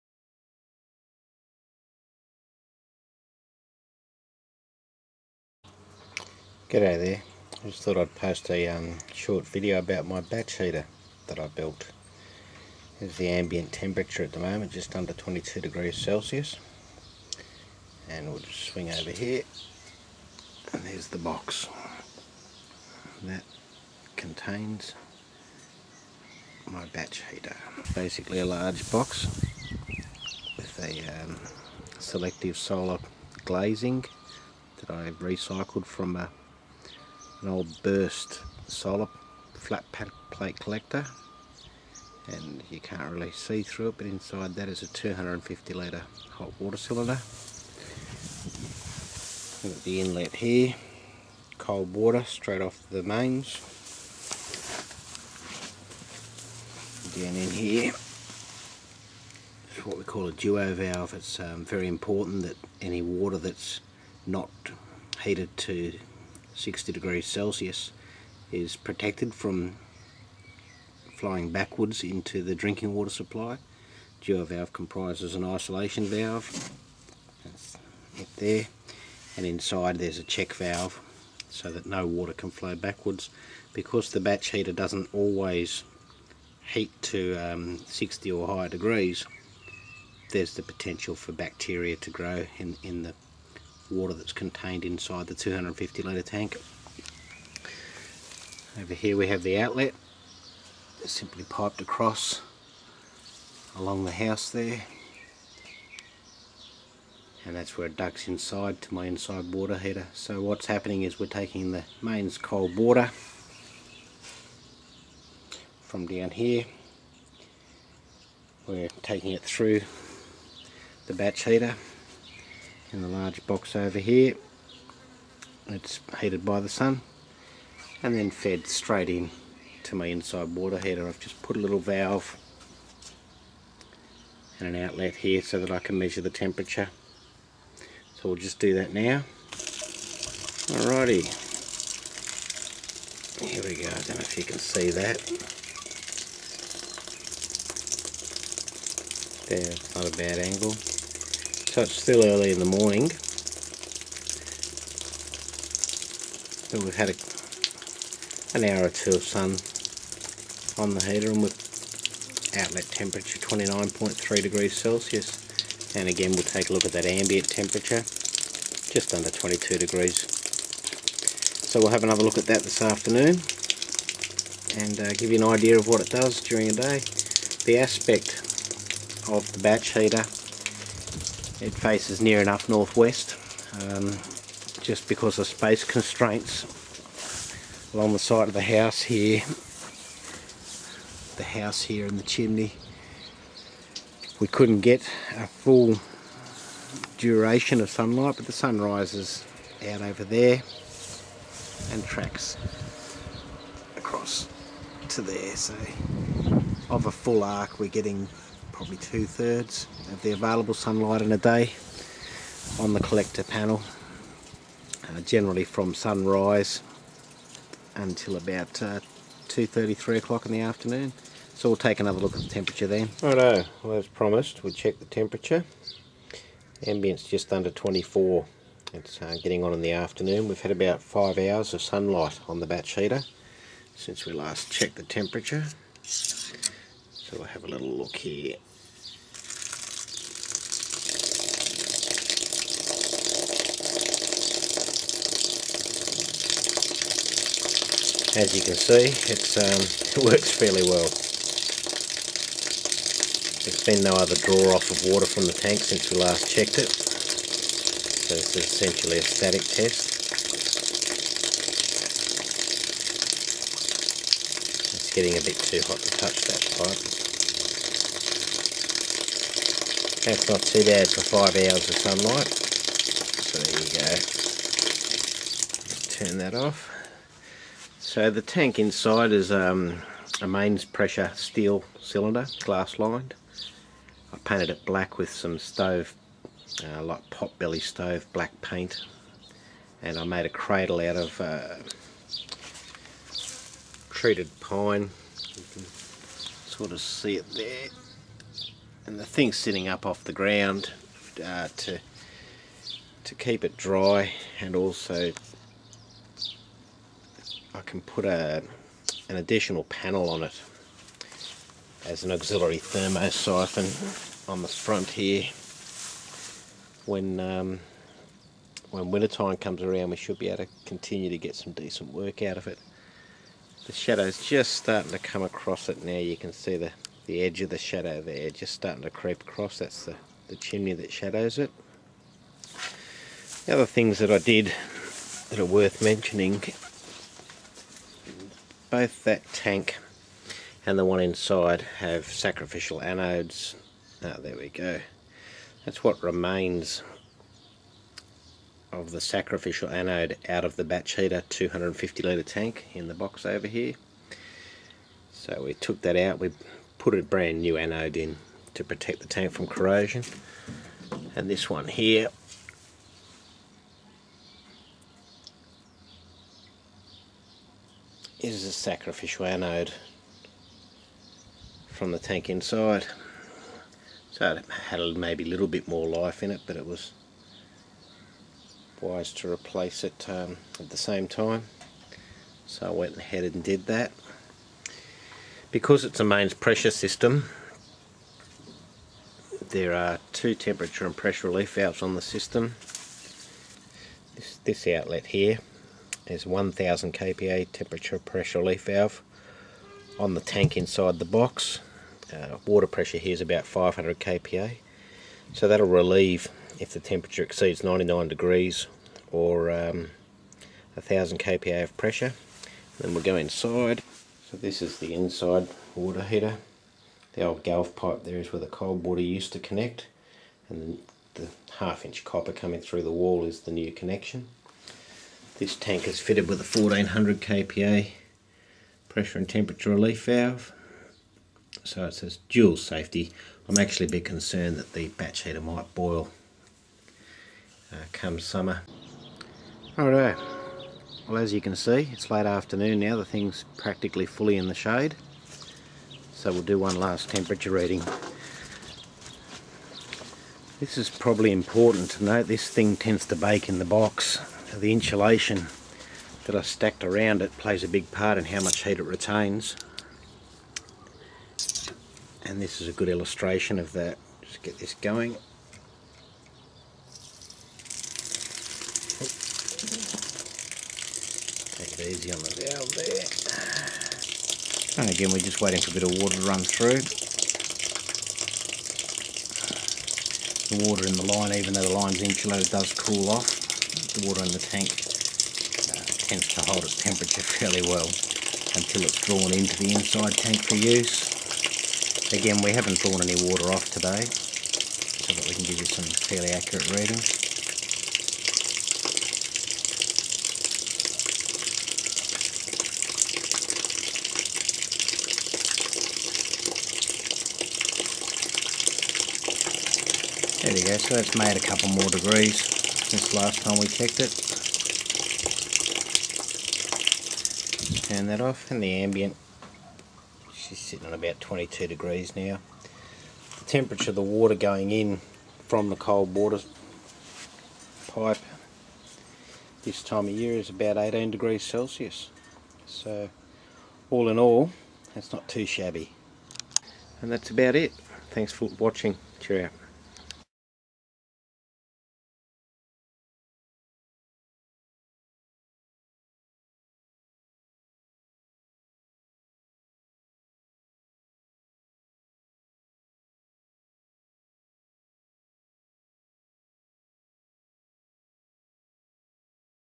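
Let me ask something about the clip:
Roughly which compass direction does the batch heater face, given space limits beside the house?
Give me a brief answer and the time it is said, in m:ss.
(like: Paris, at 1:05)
Northwest, at 3:02.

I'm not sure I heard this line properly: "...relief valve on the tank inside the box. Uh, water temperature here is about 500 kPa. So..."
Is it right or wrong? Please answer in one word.
wrong.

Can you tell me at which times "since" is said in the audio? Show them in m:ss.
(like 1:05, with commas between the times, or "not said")
3:53, 4:15, 8:33.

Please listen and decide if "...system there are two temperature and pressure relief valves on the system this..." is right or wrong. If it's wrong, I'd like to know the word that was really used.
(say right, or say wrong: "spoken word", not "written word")
right.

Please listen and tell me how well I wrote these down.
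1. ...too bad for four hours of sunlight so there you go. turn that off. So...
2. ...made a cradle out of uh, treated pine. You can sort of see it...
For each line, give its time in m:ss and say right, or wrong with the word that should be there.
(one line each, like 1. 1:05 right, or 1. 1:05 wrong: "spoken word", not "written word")
1. 4:30 wrong: "five", not "four"
2. 4:50 right.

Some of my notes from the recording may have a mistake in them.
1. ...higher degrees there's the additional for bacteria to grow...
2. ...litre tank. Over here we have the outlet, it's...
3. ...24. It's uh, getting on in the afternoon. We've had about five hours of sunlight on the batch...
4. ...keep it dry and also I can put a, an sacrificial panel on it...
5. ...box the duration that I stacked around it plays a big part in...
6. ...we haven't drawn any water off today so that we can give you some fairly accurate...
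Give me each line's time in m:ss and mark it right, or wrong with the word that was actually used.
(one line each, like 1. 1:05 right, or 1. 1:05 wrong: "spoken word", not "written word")
1. 1:28 wrong: "potential", not "additional"
2. 1:36 right
3. 3:47 right
4. 5:03 wrong: "additional", not "sacrificial"
5. 7:33 wrong: "insulation", not "duration"
6. 8:12 right.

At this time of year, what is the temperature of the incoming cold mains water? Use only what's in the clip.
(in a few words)
About 18 degrees Celsius.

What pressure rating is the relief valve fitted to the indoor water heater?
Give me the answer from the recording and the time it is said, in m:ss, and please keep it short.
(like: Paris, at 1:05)
1400 kPa, at 7:06.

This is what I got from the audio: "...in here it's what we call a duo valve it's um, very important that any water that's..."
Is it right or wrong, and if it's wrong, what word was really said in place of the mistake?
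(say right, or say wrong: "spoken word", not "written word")
right.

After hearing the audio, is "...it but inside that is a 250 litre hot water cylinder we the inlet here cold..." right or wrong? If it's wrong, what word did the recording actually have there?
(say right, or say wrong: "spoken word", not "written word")
right.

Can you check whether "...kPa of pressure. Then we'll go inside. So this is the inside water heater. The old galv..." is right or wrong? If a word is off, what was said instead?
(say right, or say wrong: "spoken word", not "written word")
right.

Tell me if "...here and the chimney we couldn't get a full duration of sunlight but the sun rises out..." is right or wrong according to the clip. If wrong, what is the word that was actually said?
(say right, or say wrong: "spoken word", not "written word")
right.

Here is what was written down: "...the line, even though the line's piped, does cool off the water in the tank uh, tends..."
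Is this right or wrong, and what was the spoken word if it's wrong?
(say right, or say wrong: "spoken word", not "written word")
wrong: "insulated", not "piped".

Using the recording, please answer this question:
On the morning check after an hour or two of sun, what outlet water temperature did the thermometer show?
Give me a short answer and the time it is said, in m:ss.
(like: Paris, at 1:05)
29.3 degrees Celsius, at 2:43.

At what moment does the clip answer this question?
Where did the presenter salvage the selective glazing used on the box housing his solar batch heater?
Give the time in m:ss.
0:37.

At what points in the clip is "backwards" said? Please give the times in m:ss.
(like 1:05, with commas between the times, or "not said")
1:11, 1:22.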